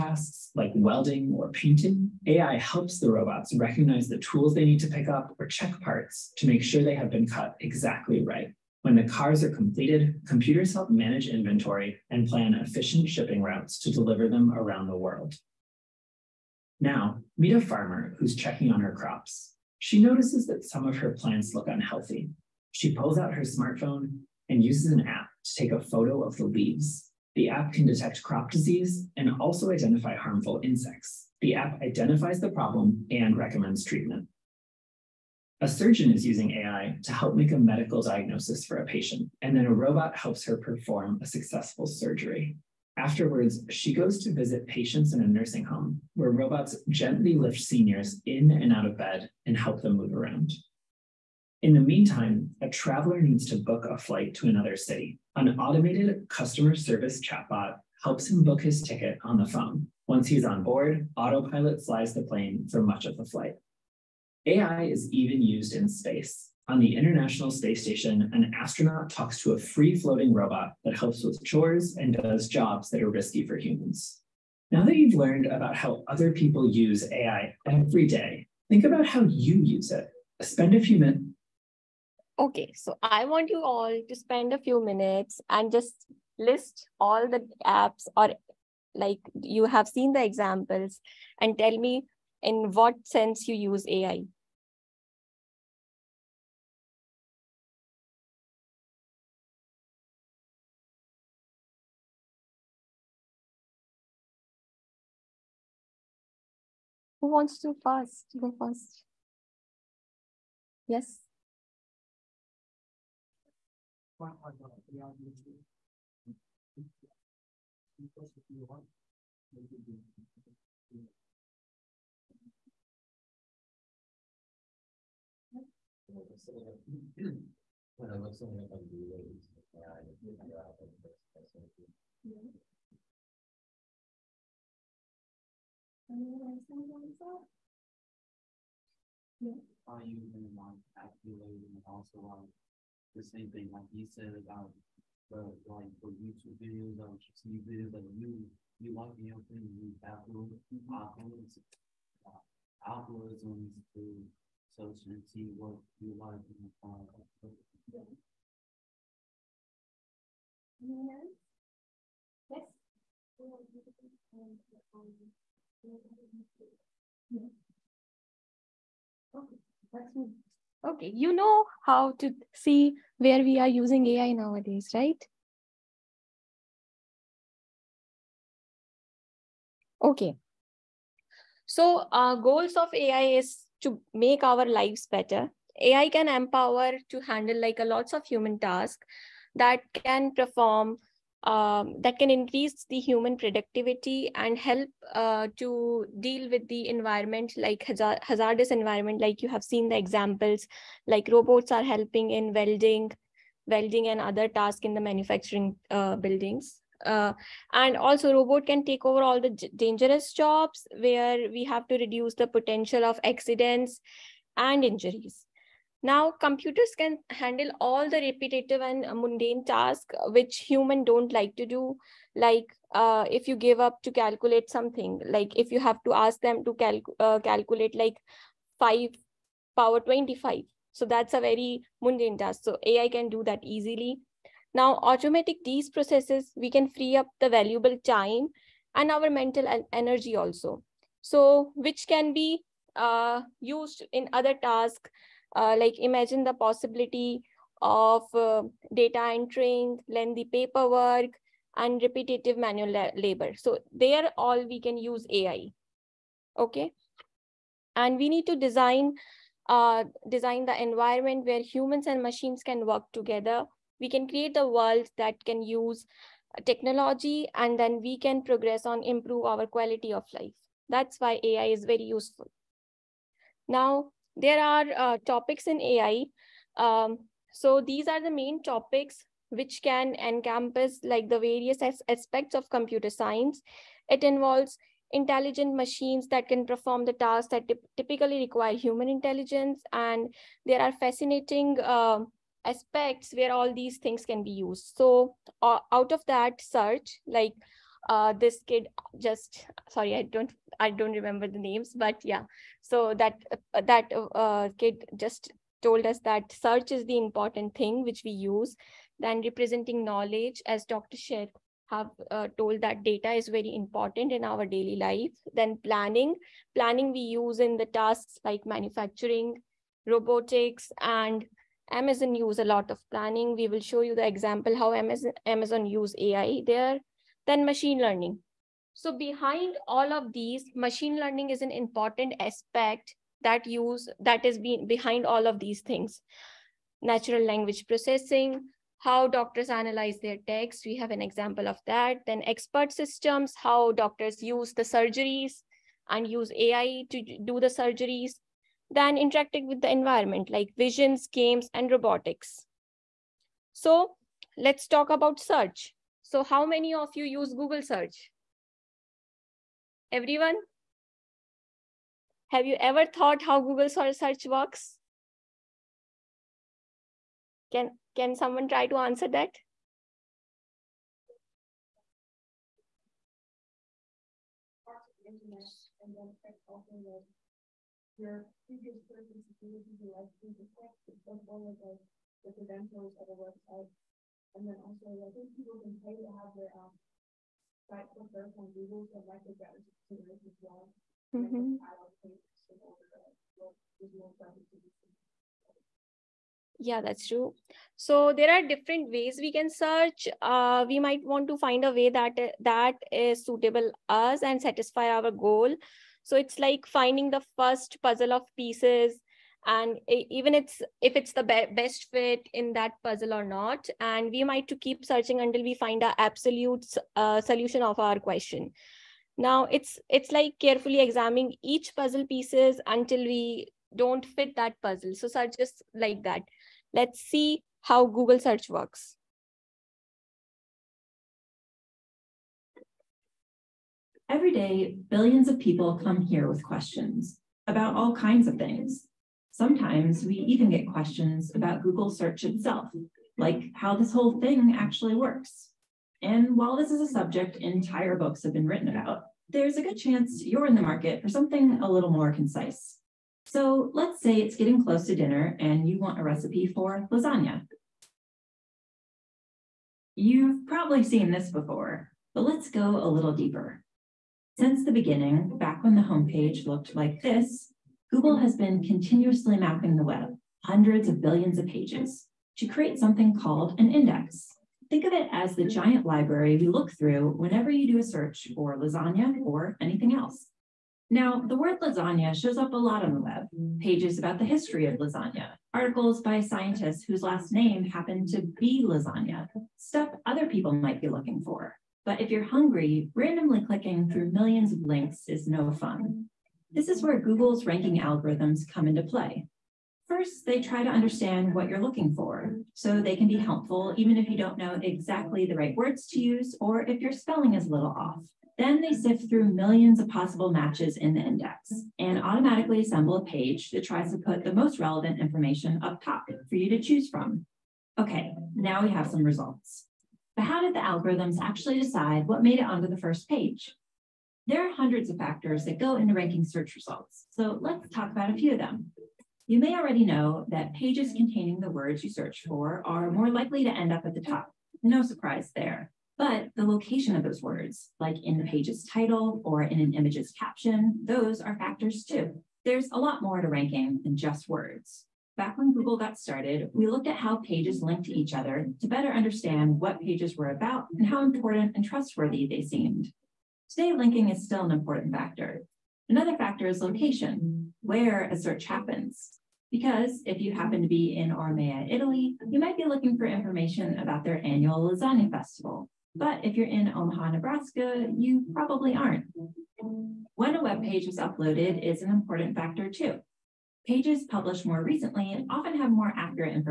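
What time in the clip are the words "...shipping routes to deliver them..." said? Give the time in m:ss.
0:13.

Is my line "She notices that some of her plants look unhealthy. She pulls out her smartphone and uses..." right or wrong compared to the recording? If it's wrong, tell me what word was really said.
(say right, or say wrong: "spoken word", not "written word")
right.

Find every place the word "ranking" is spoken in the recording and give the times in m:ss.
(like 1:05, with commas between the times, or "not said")
8:17, 8:46, 9:03.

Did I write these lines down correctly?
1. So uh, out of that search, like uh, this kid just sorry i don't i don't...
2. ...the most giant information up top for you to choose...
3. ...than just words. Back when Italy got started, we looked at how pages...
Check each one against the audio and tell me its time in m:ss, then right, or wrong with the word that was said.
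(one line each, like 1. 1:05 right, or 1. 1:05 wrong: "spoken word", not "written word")
1. 4:54 right
2. 8:34 wrong: "relevant", not "giant"
3. 9:04 wrong: "Google", not "Italy".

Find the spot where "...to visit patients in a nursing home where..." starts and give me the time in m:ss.
0:44.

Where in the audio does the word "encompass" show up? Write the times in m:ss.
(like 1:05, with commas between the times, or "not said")
4:40.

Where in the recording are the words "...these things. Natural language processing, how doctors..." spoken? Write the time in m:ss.
5:35.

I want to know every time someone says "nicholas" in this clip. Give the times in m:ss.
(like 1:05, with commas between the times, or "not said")
not said.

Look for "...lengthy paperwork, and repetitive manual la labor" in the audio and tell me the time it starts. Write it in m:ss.
4:10.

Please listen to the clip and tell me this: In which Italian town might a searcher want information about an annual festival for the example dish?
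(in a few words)
Ormea.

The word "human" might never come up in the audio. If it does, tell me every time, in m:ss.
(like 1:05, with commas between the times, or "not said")
1:13, 3:08, 3:13, 3:40, 4:21, 4:48.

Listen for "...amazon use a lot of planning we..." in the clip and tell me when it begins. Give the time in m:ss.
5:21.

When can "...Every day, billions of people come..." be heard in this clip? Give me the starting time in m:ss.
7:14.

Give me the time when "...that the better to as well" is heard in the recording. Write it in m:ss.
6:29.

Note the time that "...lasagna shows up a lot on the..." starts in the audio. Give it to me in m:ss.
8:01.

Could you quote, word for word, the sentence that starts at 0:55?
An automated customer service chatbot helps him book his ticket on the phone.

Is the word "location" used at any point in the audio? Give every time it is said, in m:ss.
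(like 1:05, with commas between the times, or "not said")
8:56, 9:16.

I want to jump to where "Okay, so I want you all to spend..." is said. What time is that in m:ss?
1:22.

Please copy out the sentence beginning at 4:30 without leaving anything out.
That's why AI is very useful.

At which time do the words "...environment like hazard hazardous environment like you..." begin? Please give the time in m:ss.
3:16.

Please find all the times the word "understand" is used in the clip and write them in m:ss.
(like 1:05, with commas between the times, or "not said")
8:20, 9:09.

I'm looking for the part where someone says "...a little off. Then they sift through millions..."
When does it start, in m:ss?
8:27.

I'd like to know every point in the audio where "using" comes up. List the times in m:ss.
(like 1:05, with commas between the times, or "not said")
0:36, 2:53.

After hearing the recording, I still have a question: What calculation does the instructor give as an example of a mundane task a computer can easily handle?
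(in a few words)
5 power 25.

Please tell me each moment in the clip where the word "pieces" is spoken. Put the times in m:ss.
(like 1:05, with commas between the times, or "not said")
6:48, 7:02.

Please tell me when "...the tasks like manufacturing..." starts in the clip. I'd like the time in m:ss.
5:17.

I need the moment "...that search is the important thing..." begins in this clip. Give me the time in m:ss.
5:06.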